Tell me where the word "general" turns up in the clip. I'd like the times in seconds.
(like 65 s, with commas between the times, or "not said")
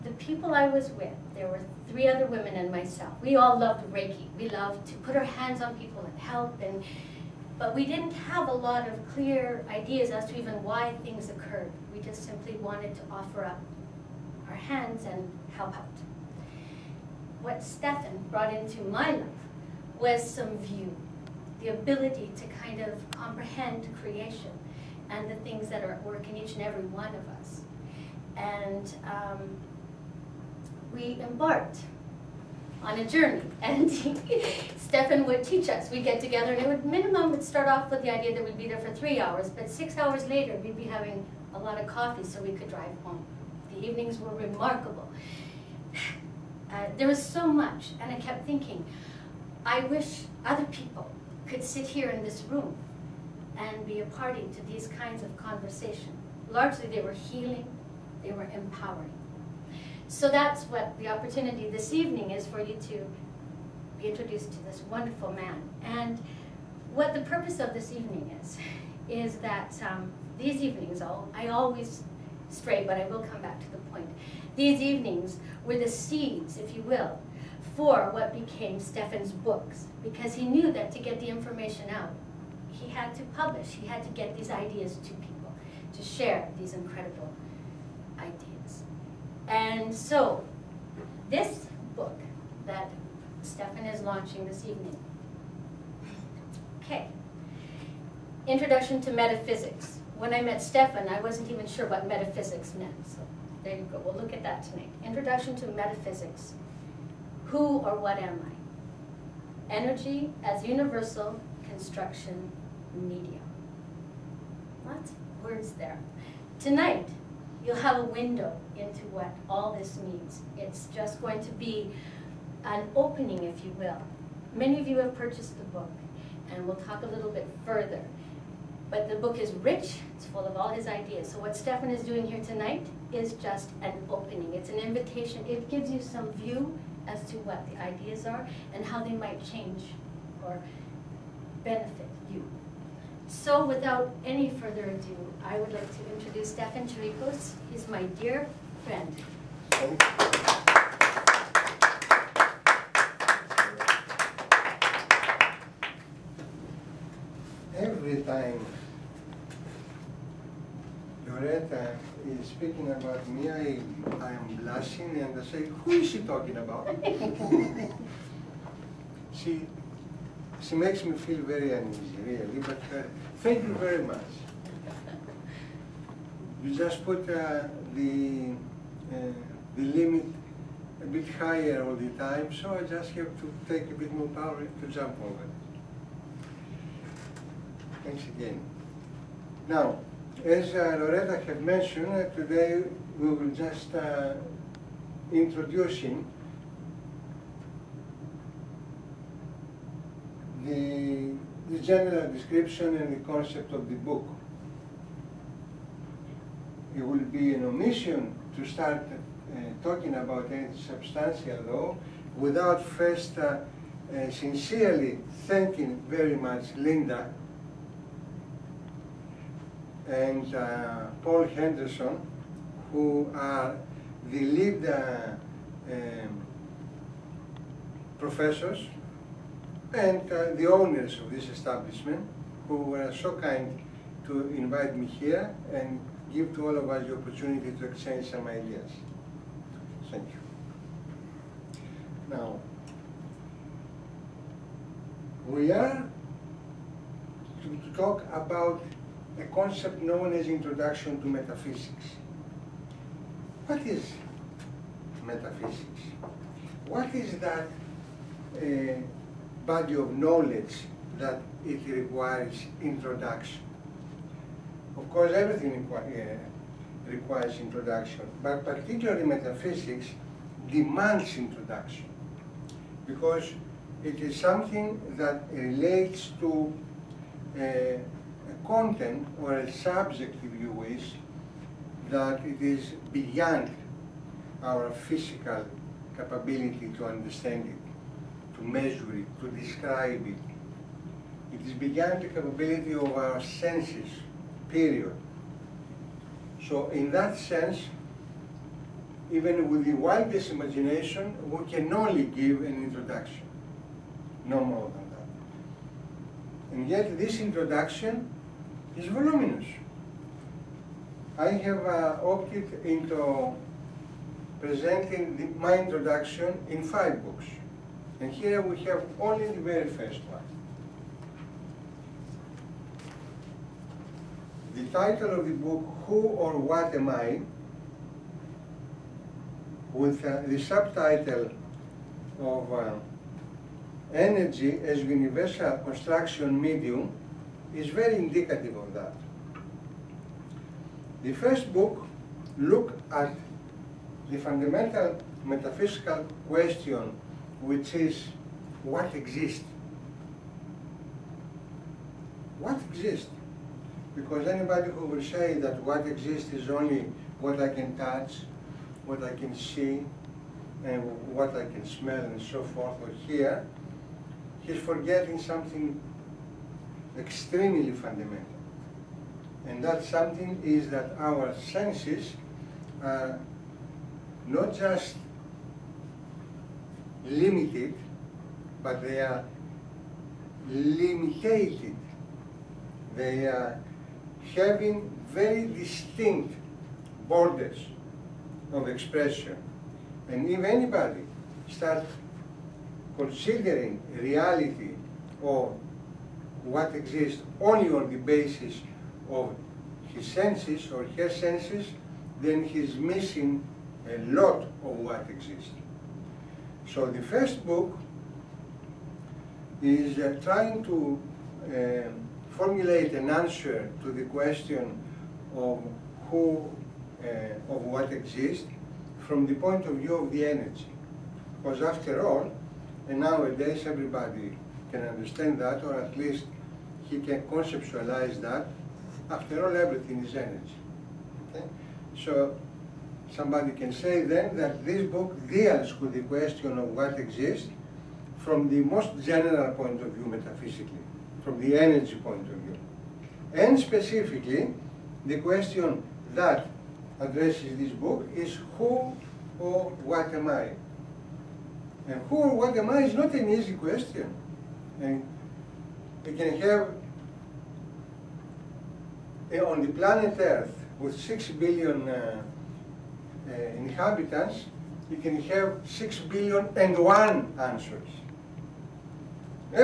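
201 s, 439 s.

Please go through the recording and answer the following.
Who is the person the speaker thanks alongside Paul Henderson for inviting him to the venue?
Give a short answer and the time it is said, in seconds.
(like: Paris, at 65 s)
Linda, at 216 s.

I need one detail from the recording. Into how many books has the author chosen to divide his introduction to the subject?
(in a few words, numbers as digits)
5.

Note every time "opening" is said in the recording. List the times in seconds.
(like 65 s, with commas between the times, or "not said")
122 s, 134 s.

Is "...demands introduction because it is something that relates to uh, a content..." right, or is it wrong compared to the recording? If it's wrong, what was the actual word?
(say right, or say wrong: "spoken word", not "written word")
right.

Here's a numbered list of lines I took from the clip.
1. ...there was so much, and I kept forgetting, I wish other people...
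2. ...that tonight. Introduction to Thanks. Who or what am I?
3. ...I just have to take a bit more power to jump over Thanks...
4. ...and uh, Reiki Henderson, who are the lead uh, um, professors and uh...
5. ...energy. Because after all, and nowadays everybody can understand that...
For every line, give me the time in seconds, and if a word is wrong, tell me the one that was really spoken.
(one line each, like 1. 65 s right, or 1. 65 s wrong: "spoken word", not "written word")
1. 46 s wrong: "thinking", not "forgetting"
2. 104 s wrong: "Metaphysics", not "Thanks"
3. 182 s right
4. 220 s wrong: "Paul", not "Reiki"
5. 420 s right.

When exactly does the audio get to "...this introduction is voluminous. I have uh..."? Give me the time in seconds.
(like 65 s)
307 s.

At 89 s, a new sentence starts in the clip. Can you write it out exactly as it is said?
And so, this book that Stefan is launching this evening.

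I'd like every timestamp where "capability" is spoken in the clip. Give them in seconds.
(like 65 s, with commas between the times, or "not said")
286 s, 292 s.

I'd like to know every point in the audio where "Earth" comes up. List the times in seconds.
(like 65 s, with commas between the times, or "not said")
460 s.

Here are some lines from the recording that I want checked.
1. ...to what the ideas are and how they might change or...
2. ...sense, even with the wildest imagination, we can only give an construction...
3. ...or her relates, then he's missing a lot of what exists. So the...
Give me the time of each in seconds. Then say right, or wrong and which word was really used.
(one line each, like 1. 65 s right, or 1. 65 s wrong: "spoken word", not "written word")
1. 137 s right
2. 297 s wrong: "introduction", not "construction"
3. 400 s wrong: "senses", not "relates".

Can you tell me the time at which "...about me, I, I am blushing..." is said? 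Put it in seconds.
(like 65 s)
162 s.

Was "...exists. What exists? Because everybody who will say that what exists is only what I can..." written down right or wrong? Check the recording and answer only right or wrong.
wrong.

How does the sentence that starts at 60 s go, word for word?
So that's what the opportunity this evening is for you to be introduced to this wonderful man.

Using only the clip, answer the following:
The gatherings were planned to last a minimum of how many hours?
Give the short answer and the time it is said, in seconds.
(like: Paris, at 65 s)
3, at 38 s.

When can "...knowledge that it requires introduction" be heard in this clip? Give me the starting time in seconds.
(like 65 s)
260 s.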